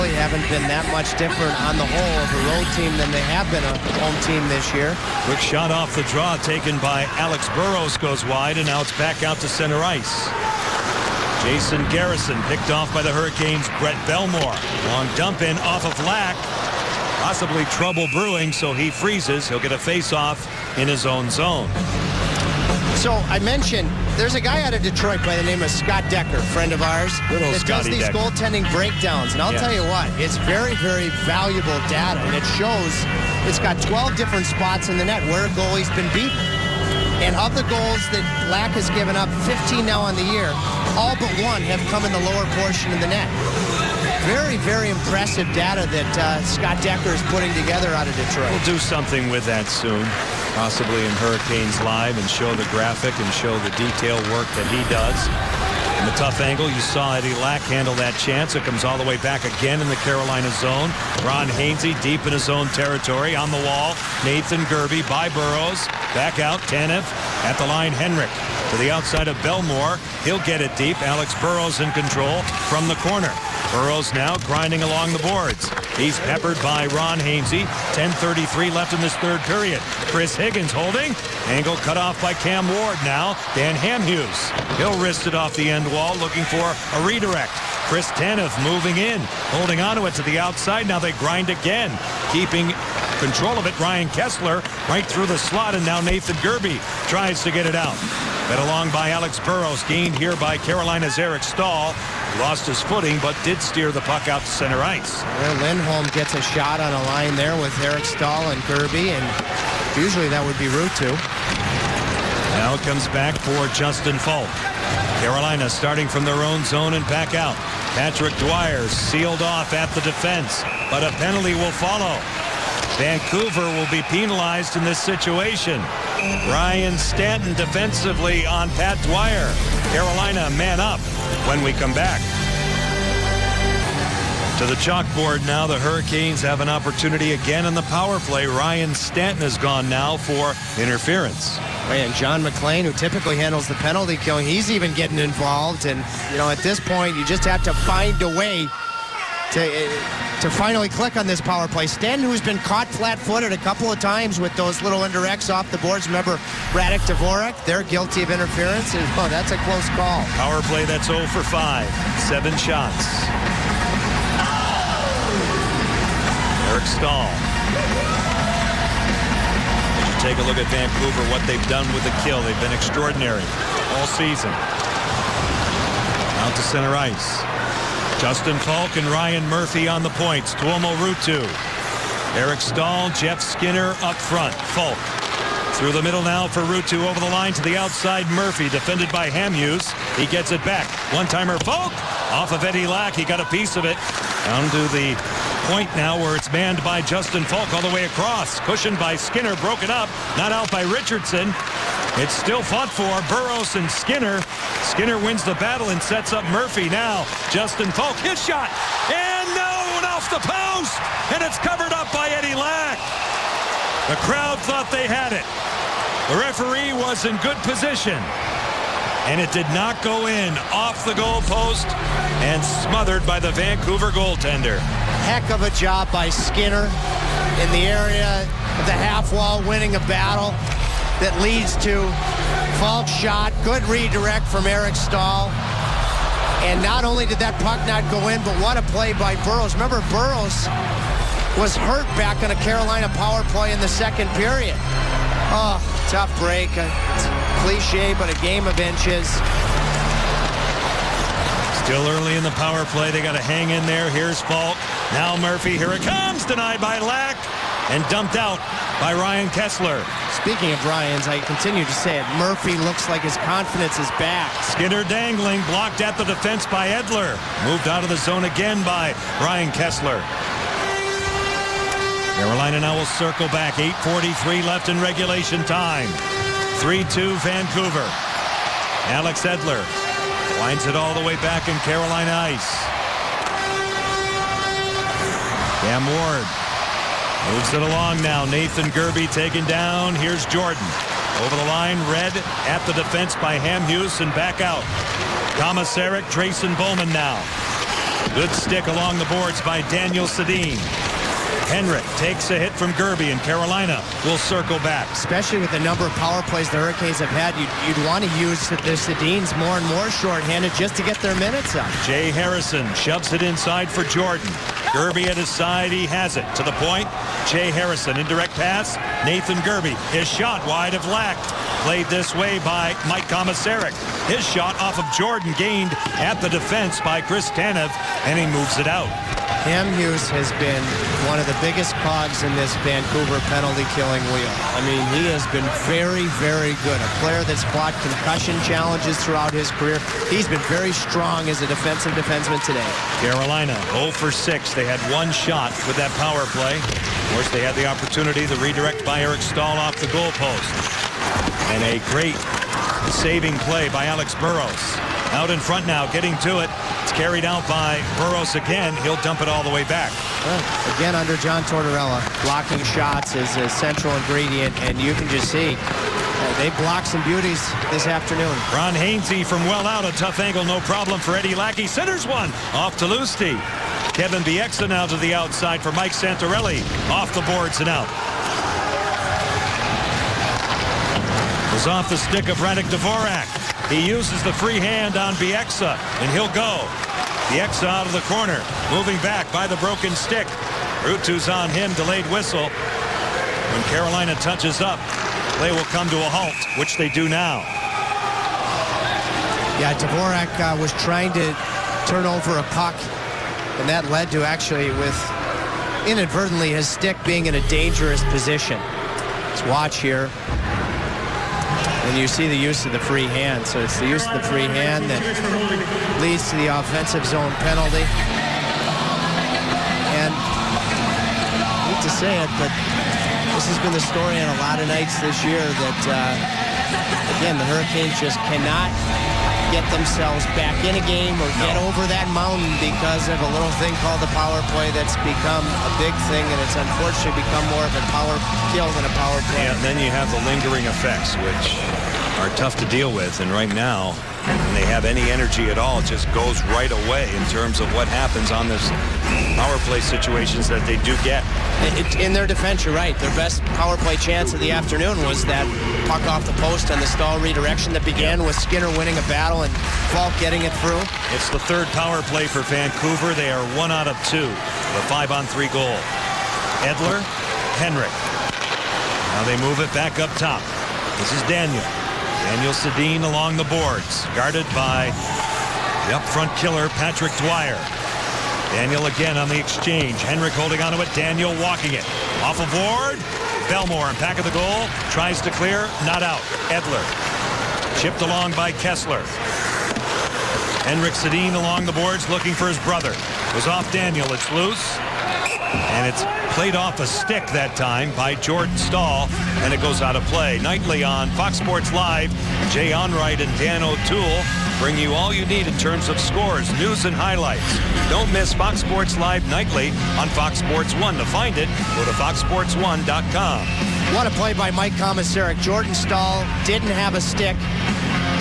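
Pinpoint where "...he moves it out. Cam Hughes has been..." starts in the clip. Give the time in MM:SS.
05:28.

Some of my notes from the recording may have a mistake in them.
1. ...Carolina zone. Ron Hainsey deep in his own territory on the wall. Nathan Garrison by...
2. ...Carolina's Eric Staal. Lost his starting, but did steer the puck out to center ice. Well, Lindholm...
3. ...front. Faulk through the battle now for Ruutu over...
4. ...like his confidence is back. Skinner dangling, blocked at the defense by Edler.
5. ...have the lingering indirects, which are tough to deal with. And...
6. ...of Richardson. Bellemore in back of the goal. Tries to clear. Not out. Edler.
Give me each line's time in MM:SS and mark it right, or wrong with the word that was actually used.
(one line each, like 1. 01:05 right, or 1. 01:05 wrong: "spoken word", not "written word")
1. 00:59 wrong: "Gerbe", not "Garrison"
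2. 01:40 wrong: "footing", not "starting"
3. 03:04 wrong: "middle", not "battle"
4. 04:23 right
5. 07:20 wrong: "effects", not "indirects"
6. 08:02 wrong: "Ward", not "Richardson".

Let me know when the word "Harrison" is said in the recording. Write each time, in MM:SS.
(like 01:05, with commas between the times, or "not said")
05:12, 05:17.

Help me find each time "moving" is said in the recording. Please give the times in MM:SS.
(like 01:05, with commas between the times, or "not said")
01:28, 06:28.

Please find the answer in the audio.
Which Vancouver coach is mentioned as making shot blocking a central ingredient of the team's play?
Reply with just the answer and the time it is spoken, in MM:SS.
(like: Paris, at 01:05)
John Tortorella, at 06:01.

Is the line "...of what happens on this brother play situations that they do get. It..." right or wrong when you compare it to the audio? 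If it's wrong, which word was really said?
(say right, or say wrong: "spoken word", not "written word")
wrong: "power", not "brother".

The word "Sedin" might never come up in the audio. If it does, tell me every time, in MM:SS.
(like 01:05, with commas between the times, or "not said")
05:00, 05:08, 07:52, 08:11.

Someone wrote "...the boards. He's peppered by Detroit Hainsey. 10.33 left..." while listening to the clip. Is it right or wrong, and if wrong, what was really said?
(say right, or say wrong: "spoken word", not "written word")
wrong: "Ron", not "Detroit".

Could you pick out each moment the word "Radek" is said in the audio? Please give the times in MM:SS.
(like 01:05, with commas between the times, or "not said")
02:36, 06:22.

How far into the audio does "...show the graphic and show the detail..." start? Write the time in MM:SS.
00:52.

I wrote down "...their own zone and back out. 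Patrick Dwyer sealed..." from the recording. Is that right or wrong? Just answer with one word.
right.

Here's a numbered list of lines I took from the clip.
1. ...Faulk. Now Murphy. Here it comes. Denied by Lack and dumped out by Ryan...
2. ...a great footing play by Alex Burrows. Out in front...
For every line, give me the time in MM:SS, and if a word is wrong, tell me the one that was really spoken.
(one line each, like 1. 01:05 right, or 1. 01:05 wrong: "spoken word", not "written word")
1. 04:14 right
2. 05:51 wrong: "saving", not "footing".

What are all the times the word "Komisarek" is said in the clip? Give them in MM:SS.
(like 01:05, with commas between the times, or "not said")
04:55, 05:23, 08:34.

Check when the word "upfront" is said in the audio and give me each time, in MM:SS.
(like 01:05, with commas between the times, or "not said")
07:56.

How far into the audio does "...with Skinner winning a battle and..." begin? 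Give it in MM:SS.
07:38.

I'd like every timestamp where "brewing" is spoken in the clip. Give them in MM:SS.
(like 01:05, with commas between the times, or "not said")
00:18.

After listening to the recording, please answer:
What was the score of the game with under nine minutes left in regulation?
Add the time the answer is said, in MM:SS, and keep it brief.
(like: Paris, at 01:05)
3-2 Vancouver, at 04:36.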